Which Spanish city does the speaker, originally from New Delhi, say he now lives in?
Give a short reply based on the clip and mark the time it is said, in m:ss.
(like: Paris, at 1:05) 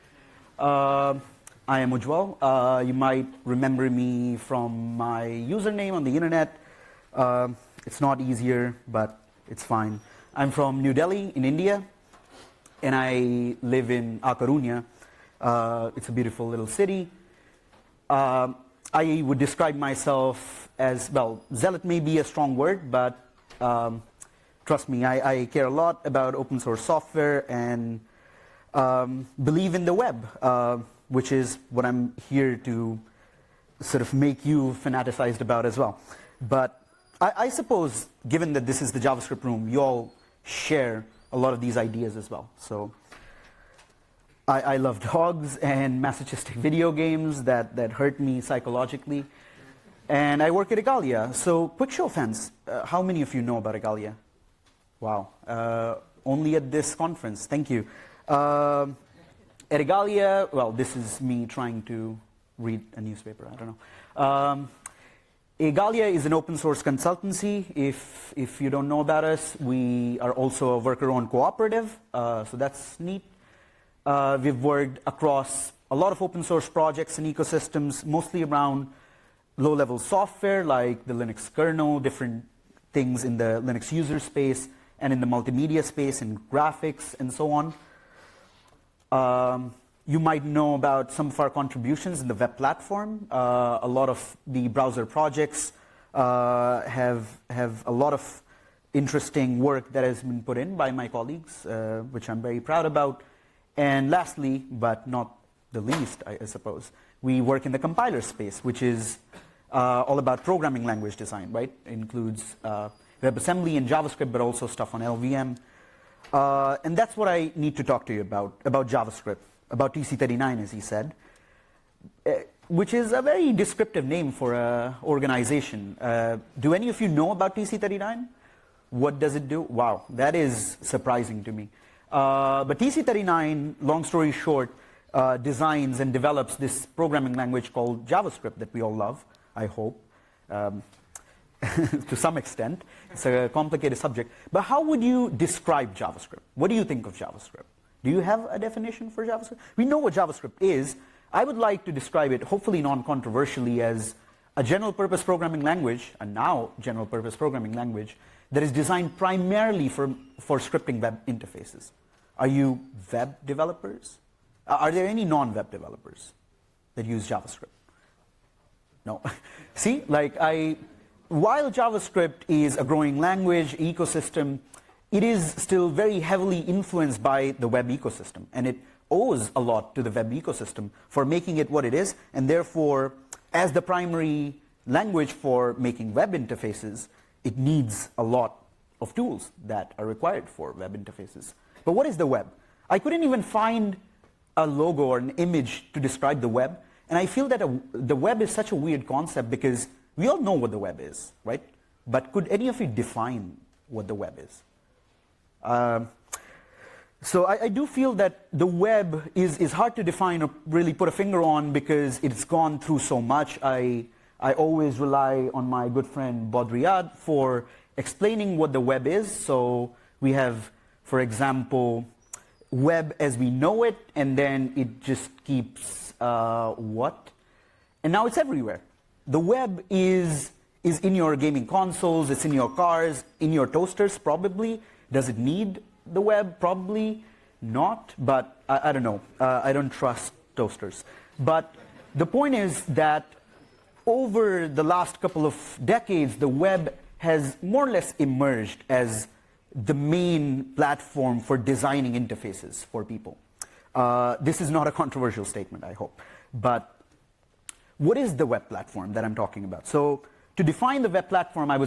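A Coruña, at 0:14.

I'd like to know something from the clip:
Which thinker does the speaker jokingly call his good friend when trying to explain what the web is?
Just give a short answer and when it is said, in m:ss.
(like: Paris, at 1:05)
Baudrillard, at 3:36.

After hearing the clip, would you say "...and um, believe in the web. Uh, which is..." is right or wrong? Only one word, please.
right.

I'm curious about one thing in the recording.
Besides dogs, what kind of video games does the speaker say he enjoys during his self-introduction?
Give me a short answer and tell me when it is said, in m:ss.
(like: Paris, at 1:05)
masochistic video games, at 0:45.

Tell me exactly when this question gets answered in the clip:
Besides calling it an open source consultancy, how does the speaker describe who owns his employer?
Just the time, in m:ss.
1:10.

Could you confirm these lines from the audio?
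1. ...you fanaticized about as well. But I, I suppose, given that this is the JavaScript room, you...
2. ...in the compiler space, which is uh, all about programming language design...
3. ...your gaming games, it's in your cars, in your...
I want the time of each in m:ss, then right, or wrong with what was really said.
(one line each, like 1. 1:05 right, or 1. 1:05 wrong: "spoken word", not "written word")
1. 0:34 right
2. 1:47 right
3. 3:51 wrong: "consoles", not "games".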